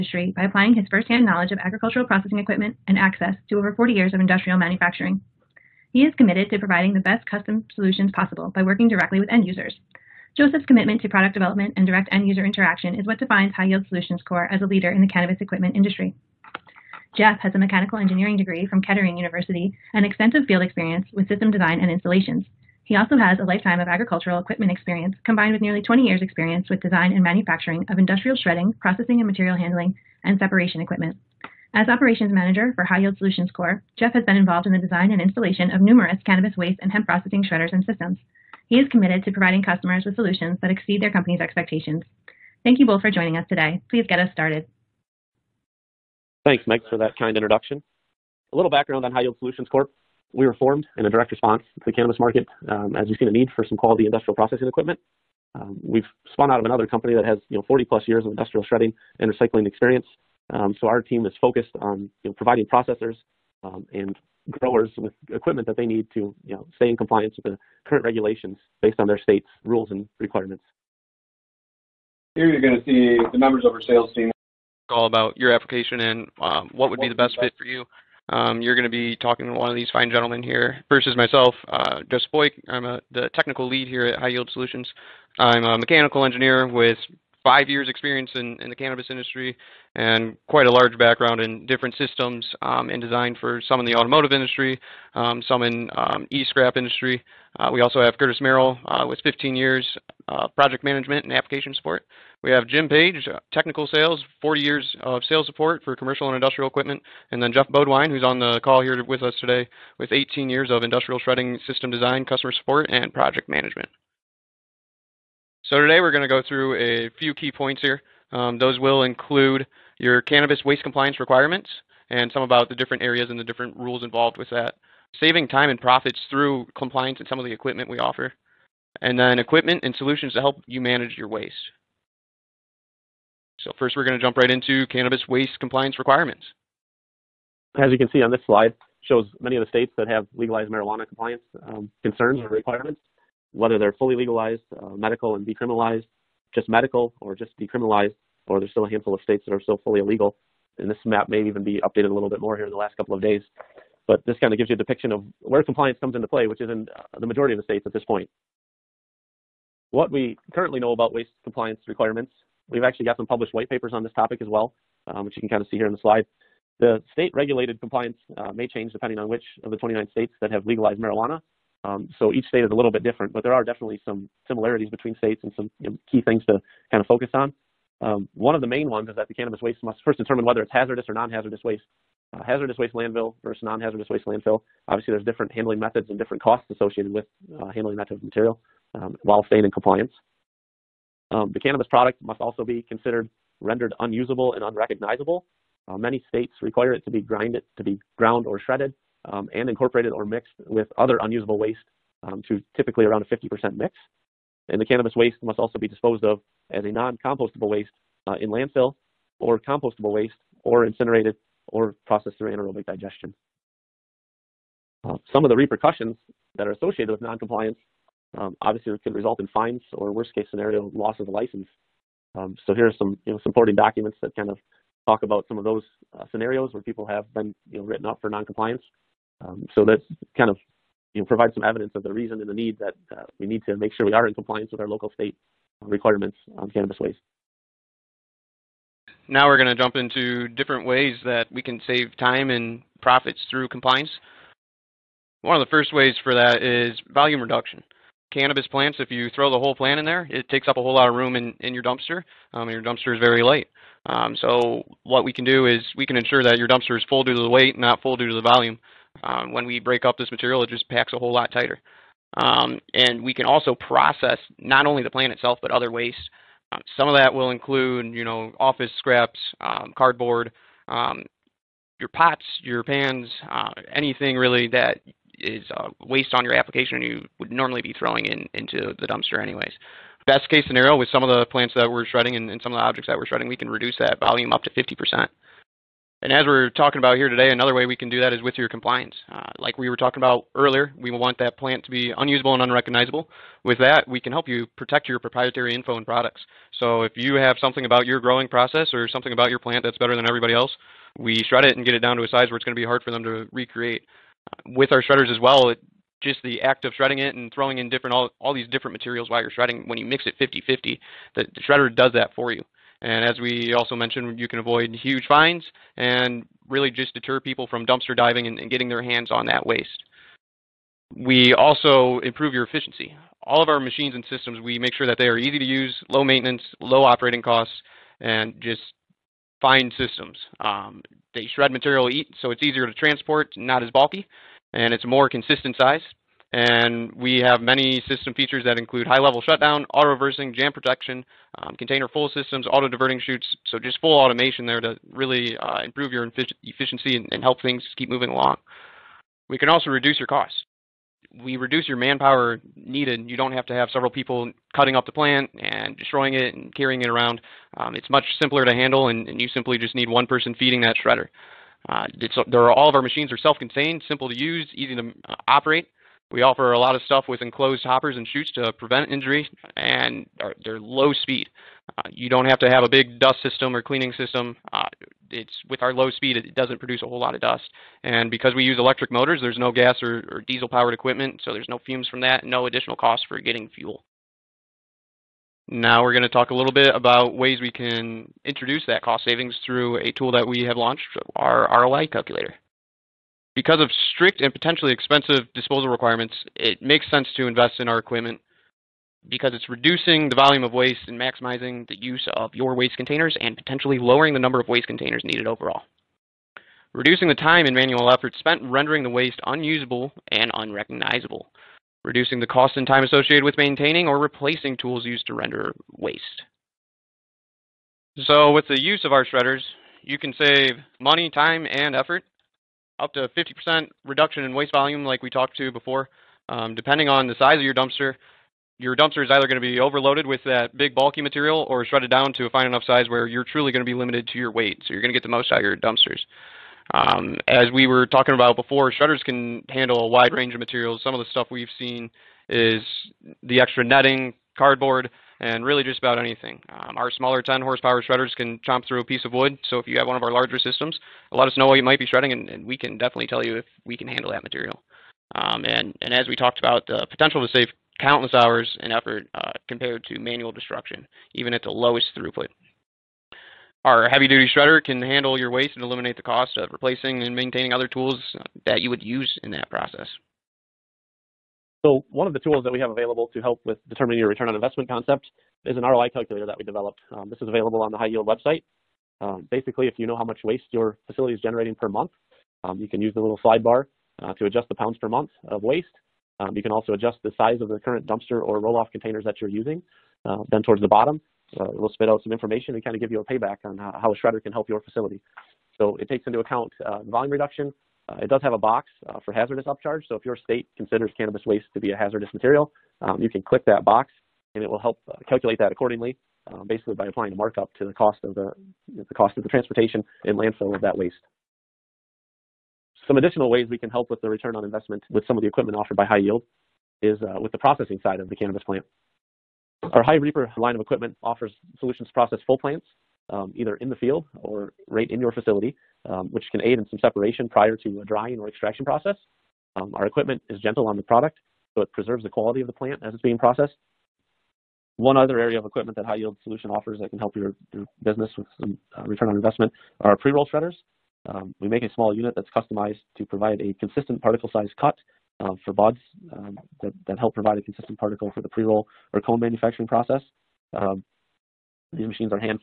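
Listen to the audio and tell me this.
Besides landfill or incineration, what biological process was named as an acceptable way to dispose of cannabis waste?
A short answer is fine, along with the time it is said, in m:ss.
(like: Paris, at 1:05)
anaerobic digestion, at 3:32.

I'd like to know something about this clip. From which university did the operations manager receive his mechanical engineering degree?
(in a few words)
Kettering University.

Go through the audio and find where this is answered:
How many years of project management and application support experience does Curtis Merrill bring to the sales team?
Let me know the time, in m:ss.
1:39.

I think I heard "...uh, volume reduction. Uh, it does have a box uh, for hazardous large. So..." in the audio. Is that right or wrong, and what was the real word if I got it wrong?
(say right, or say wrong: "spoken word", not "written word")
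wrong: "upcharge", not "large".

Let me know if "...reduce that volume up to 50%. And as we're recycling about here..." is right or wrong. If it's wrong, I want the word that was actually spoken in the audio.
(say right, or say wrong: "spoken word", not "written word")
wrong: "talking", not "recycling".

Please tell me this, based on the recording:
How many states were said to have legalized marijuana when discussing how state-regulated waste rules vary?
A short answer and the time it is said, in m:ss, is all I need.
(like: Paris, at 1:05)
29, at 2:49.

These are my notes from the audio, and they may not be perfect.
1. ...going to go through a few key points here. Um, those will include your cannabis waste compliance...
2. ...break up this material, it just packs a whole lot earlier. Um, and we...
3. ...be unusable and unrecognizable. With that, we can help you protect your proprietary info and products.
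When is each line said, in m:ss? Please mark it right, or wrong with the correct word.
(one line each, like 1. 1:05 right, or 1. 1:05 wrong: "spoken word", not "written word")
1. 1:56 right
2. 4:19 wrong: "tighter", not "earlier"
3. 4:51 right.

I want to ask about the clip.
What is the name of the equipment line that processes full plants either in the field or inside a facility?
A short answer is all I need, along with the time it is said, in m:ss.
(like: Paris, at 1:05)
High Reaper, at 8:40.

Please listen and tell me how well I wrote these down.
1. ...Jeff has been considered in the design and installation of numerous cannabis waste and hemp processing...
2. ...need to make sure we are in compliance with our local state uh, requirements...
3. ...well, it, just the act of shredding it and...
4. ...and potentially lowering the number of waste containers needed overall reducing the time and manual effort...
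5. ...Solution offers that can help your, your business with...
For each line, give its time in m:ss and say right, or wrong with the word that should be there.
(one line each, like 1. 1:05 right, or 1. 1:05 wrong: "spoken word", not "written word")
1. 0:33 wrong: "involved", not "considered"
2. 3:53 right
3. 5:05 right
4. 6:43 right
5. 8:56 right.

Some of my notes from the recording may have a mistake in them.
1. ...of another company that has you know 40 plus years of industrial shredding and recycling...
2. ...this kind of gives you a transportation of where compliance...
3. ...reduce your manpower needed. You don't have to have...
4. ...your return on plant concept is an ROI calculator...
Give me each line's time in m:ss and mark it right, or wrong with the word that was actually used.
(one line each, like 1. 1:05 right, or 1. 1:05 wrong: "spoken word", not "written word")
1. 0:56 right
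2. 2:34 wrong: "depiction", not "transportation"
3. 5:51 right
4. 7:54 wrong: "investment", not "plant".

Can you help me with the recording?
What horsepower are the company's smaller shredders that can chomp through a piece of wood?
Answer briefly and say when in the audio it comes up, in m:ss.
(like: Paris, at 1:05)
10 horsepower, at 7:27.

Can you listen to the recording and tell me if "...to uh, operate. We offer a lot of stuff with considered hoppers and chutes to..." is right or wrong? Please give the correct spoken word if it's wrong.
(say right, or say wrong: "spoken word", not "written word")
wrong: "enclosed", not "considered".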